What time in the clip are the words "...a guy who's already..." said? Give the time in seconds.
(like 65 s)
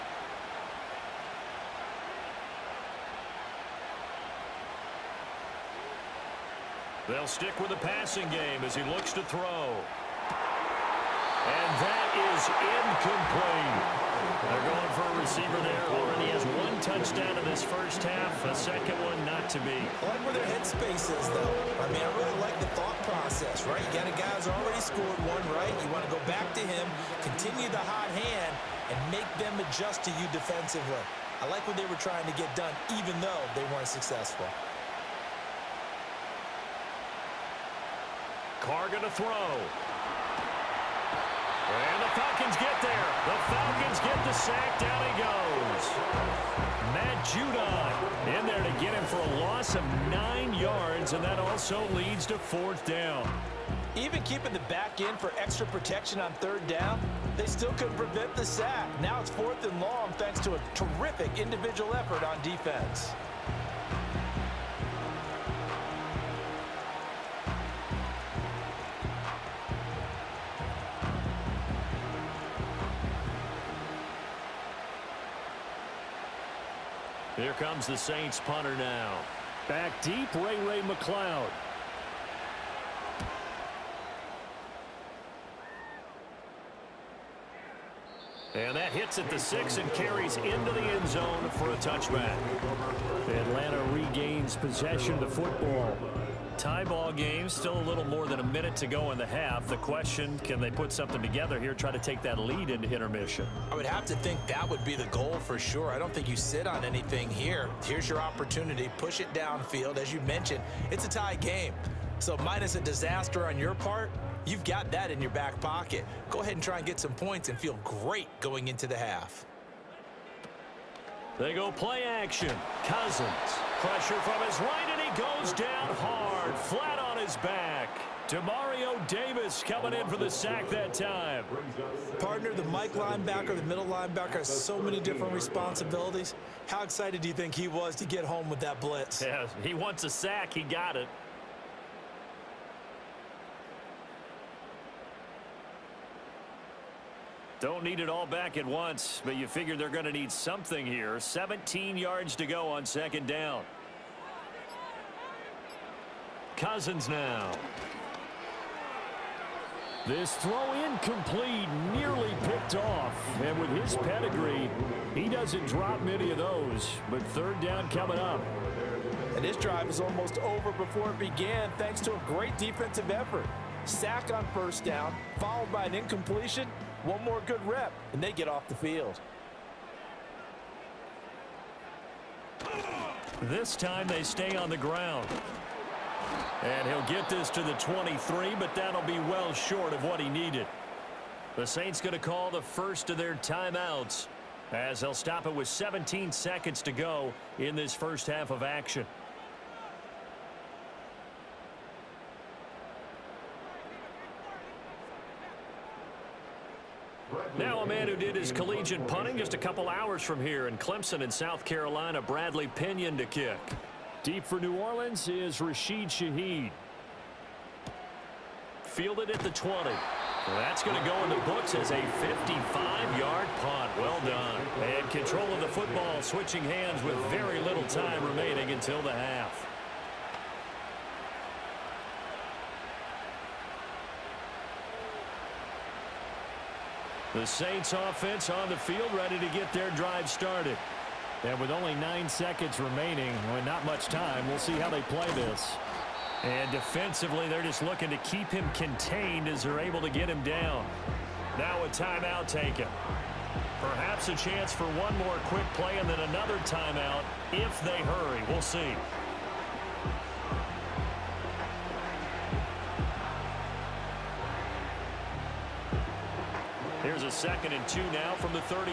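24 s.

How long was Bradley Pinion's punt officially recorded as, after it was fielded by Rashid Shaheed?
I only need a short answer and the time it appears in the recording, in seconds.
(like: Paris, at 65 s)
55 yards, at 222 s.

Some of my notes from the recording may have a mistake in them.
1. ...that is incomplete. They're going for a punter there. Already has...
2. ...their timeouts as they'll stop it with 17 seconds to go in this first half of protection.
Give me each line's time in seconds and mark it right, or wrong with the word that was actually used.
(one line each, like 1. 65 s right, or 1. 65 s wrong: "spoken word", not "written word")
1. 11 s wrong: "receiver", not "punter"
2. 193 s wrong: "action", not "protection".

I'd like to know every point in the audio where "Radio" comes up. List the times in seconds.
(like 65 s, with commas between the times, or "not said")
not said.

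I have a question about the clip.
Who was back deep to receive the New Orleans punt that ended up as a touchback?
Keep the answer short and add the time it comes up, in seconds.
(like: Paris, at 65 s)
Ray Ray McCloud, at 80 s.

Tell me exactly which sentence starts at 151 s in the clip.
17 yards to go on second down.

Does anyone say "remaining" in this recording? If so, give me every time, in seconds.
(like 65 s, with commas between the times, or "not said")
228 s, 242 s.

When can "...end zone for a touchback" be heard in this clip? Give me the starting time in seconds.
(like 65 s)
90 s.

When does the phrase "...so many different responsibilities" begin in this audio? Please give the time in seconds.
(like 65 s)
134 s.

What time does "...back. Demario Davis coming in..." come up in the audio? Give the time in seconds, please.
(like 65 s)
127 s.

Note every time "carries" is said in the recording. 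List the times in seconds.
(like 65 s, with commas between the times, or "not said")
89 s.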